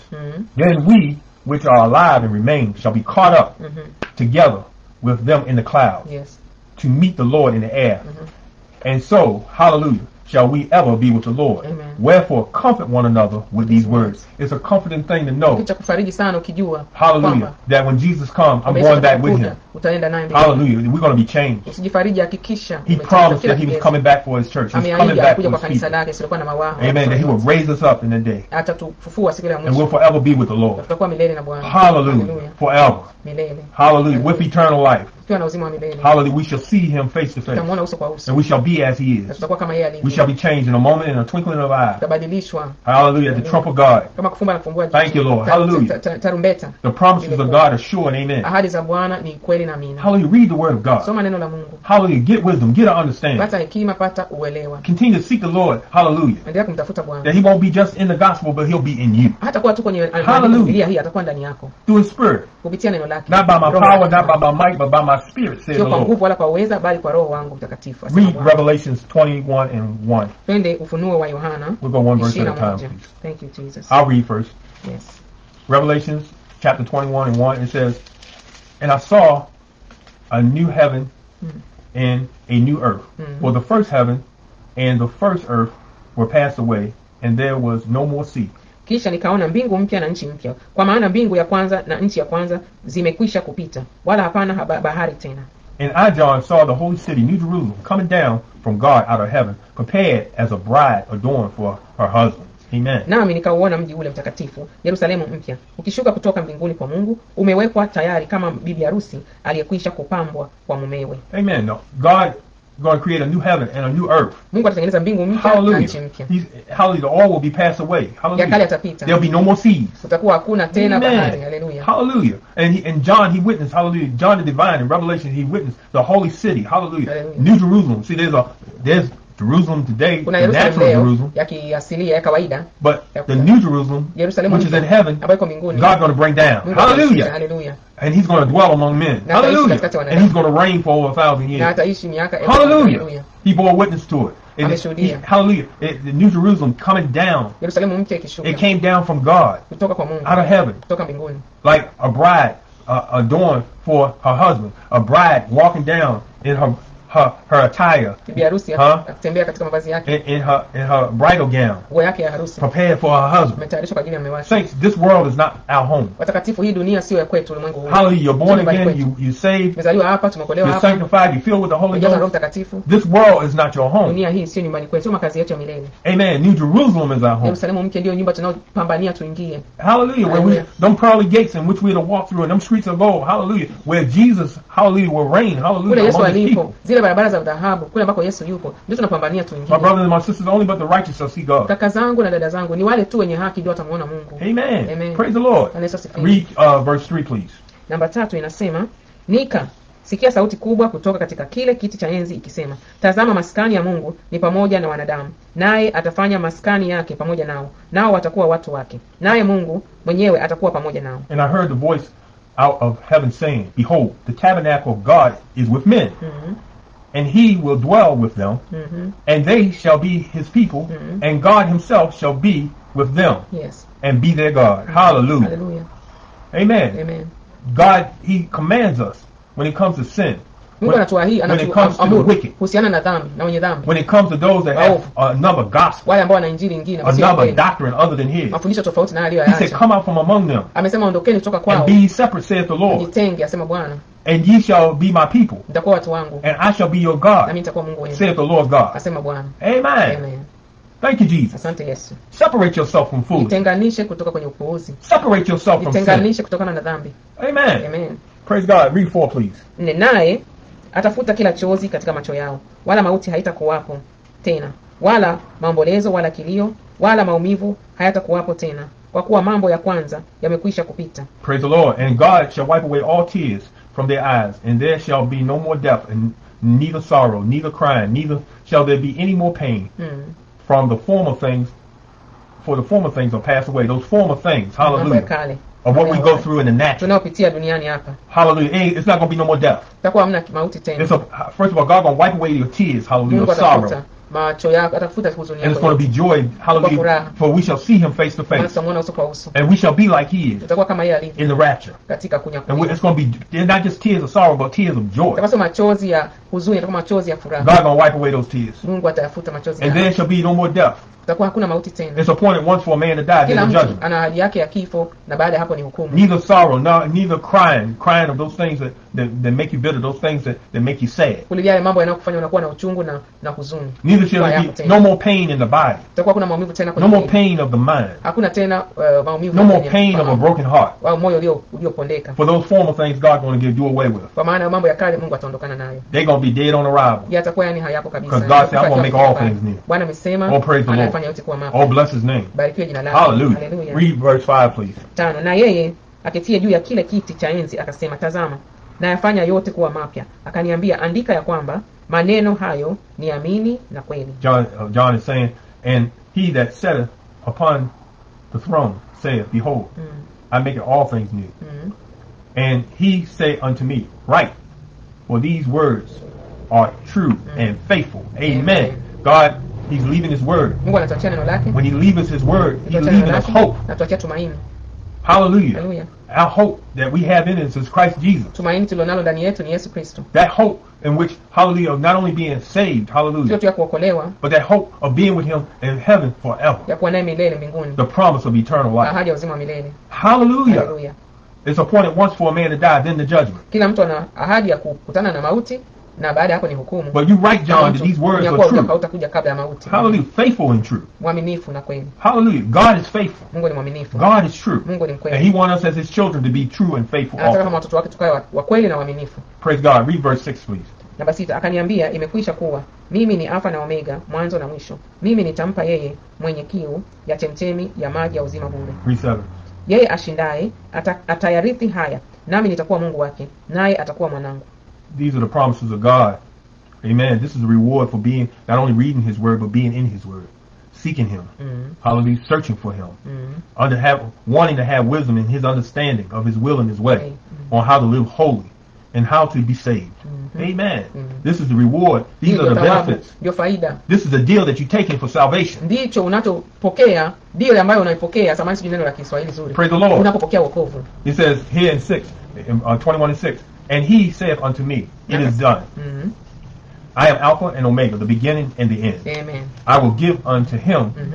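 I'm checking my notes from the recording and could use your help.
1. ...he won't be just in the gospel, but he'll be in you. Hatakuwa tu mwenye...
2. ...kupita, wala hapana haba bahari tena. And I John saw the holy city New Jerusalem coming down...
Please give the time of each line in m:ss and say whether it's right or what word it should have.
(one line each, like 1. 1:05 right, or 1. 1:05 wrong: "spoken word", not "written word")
1. 0:57 wrong: "kwenye", not "mwenye"
2. 1:33 right.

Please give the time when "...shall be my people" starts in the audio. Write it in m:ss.
4:04.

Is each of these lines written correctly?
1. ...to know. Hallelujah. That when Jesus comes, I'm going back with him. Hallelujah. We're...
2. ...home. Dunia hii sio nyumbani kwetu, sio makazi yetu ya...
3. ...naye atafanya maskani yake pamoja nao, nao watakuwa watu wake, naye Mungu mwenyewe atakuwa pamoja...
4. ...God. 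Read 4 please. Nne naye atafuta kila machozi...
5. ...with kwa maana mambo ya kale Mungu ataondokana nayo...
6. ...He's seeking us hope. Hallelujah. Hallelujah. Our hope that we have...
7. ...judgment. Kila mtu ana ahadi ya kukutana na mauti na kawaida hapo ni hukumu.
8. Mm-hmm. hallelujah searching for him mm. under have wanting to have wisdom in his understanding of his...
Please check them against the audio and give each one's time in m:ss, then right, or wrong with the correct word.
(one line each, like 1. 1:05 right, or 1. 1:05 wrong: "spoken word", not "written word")
1. 0:15 right
2. 2:53 right
3. 3:25 right
4. 4:18 wrong: "chozi", not "machozi"
5. 5:34 right
6. 6:12 wrong: "leaving", not "seeking"
7. 6:33 wrong: "baada", not "kawaida"
8. 7:11 right.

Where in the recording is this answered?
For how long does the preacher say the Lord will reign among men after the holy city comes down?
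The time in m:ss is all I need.
2:21.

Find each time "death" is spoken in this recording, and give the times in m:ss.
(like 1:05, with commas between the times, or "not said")
4:35, 4:49, 5:10.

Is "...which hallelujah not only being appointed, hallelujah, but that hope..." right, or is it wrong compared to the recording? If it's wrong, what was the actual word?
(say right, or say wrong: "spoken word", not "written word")
wrong: "saved", not "appointed".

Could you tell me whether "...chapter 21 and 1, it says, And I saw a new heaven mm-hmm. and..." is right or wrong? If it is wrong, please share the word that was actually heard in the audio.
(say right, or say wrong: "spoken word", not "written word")
right.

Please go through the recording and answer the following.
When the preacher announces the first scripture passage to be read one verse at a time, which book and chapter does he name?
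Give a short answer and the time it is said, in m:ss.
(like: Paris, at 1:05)
Revelations 21, at 1:08.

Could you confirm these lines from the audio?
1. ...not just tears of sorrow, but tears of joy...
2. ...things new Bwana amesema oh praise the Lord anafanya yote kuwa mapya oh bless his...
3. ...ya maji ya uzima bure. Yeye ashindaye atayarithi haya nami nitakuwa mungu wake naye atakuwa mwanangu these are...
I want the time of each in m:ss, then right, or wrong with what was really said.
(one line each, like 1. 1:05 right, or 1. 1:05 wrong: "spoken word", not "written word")
1. 5:03 right
2. 5:39 right
3. 6:58 right.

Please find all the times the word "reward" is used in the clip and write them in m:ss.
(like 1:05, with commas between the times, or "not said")
7:07, 7:21.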